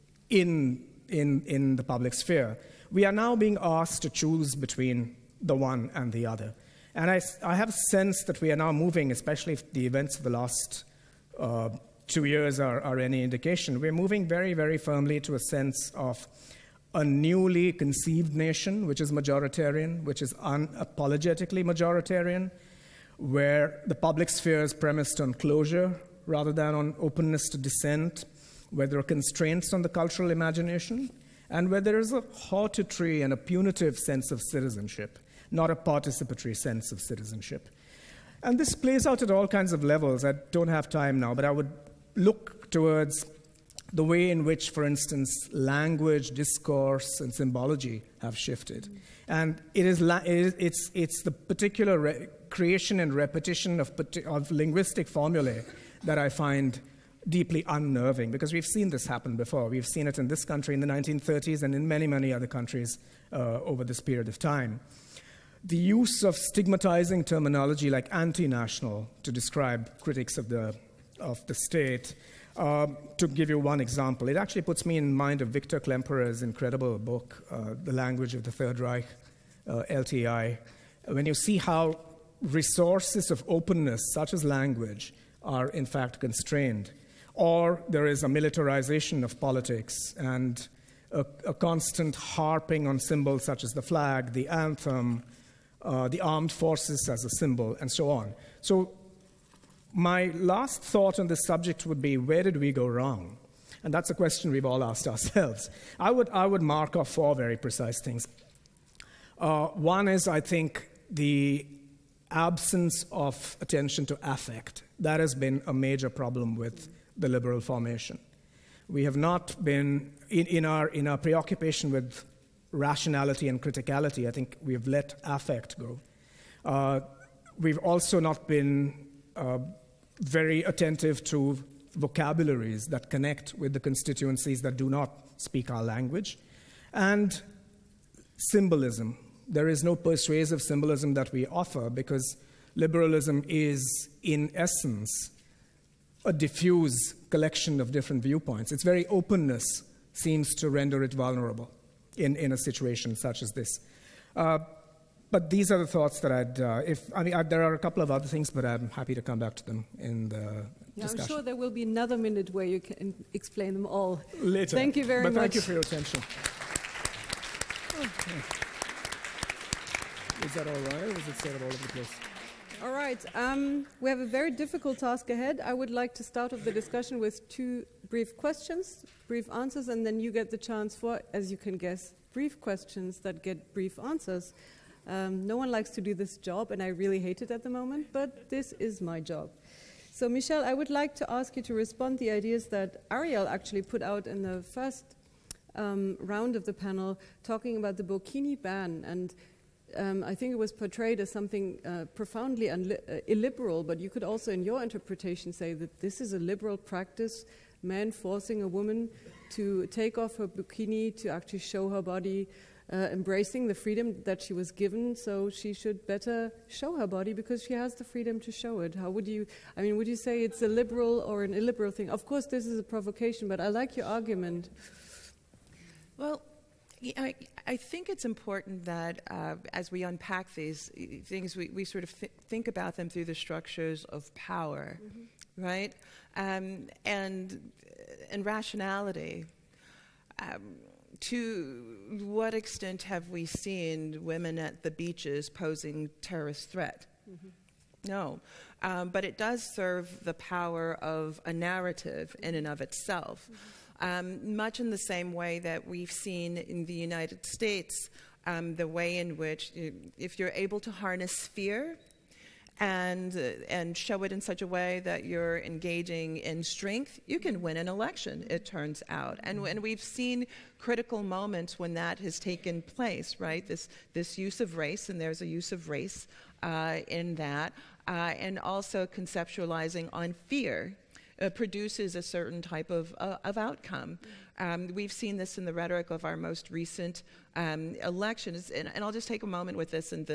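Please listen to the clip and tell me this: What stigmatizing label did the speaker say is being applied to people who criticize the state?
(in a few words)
anti-national.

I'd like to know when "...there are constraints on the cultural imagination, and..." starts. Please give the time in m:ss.
0:28.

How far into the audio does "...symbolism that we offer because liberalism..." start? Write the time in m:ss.
2:20.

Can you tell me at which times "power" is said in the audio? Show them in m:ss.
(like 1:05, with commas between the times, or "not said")
3:54, 4:10.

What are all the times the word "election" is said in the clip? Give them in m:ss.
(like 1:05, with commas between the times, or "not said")
4:27, 4:47.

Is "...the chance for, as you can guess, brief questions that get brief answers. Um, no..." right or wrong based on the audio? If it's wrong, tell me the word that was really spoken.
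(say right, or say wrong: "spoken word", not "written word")
right.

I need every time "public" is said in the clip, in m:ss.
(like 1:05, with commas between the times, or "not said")
0:01, 0:23.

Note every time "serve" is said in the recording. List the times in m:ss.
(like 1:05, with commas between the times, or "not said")
4:09.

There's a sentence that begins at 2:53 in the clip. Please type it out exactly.
Um, we have a very difficult task ahead.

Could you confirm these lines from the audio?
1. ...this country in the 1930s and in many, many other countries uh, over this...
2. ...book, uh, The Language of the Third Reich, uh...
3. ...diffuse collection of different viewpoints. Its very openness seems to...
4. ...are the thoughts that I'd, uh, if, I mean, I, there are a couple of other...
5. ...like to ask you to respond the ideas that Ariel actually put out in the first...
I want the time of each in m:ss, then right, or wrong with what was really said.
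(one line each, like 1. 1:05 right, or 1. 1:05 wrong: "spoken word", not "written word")
1. 1:00 right
2. 1:16 right
3. 2:26 right
4. 2:35 right
5. 3:10 right.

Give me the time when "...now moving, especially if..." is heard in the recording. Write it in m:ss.
0:08.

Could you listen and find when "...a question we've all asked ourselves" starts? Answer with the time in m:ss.
1:44.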